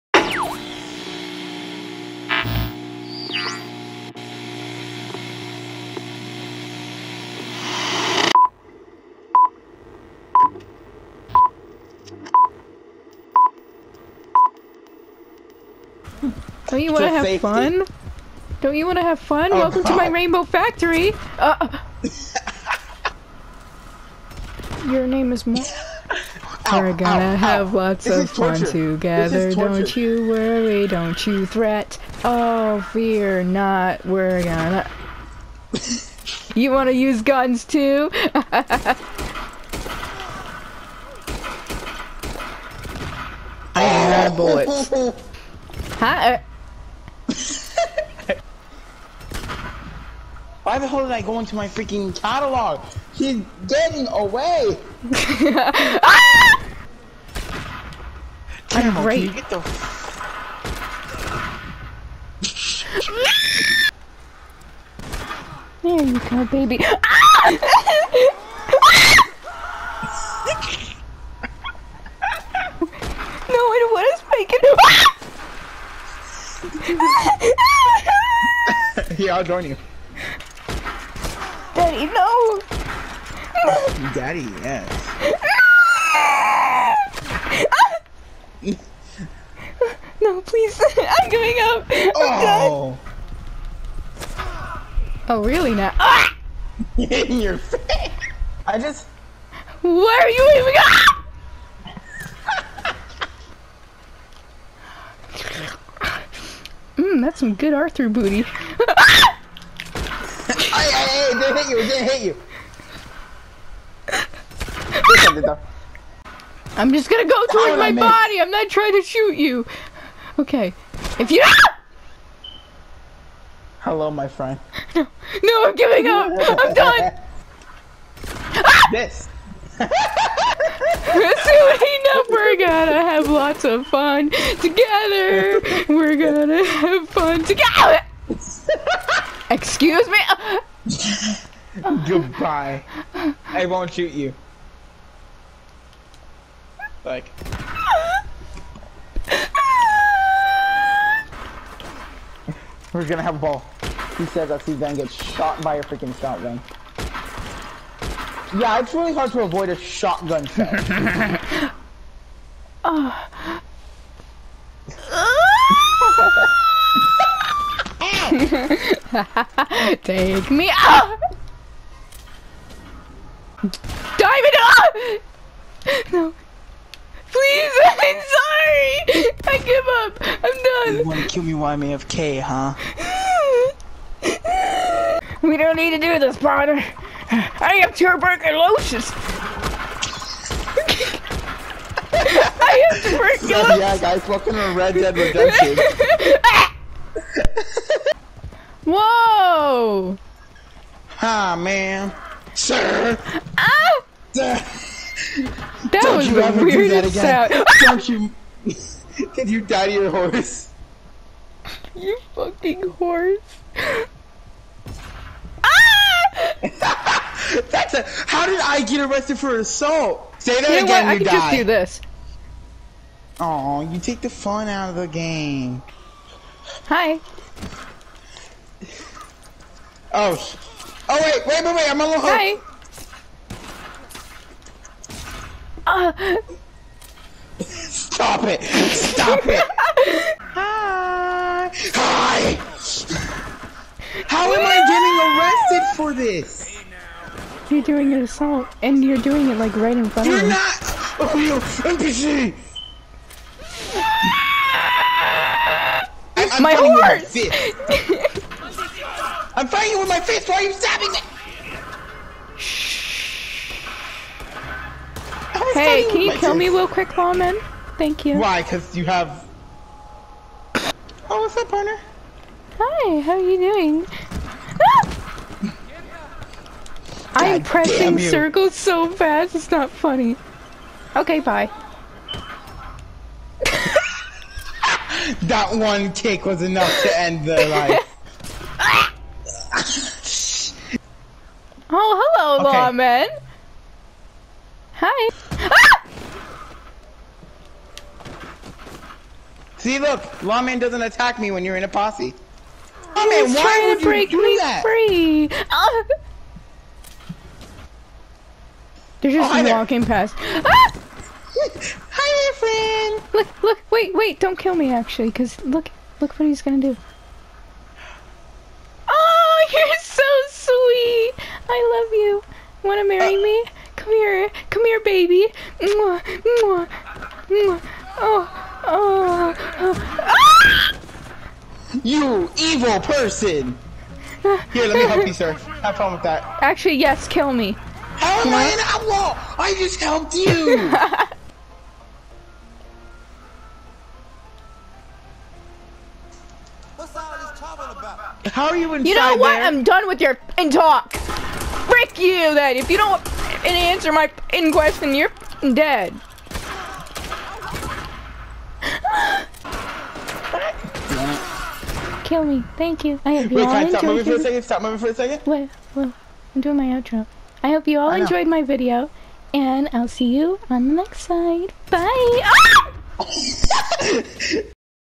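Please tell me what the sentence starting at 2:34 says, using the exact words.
He says that Steve then gets shot by a freaking shotgun.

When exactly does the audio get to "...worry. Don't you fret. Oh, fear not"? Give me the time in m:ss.
0:30.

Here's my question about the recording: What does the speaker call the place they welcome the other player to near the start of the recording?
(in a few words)
rainbow factory.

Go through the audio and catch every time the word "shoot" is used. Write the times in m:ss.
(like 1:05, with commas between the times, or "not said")
1:59, 2:23.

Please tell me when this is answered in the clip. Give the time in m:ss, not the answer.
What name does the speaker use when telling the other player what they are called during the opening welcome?
0:25.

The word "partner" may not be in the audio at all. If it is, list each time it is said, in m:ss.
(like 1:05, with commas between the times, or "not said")
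3:06, 4:31.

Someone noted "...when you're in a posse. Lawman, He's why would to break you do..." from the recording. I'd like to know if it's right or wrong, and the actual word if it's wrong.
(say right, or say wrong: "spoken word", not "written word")
right.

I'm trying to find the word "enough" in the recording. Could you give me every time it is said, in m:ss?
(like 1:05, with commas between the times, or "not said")
2:11, 4:46.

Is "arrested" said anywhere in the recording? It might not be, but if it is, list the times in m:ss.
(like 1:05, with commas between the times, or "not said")
3:39, 4:05.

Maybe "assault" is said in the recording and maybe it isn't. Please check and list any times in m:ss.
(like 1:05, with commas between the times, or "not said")
3:39, 4:08.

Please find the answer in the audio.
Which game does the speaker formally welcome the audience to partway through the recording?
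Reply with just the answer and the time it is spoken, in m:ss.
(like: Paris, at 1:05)
Red Dead Redemption, at 3:14.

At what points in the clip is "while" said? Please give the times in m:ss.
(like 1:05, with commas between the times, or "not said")
3:01.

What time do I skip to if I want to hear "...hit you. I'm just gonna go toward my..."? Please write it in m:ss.
1:52.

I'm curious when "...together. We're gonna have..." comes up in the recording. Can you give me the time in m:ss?
2:14.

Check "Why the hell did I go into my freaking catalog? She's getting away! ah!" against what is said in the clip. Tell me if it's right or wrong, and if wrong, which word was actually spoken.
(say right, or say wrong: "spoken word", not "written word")
right.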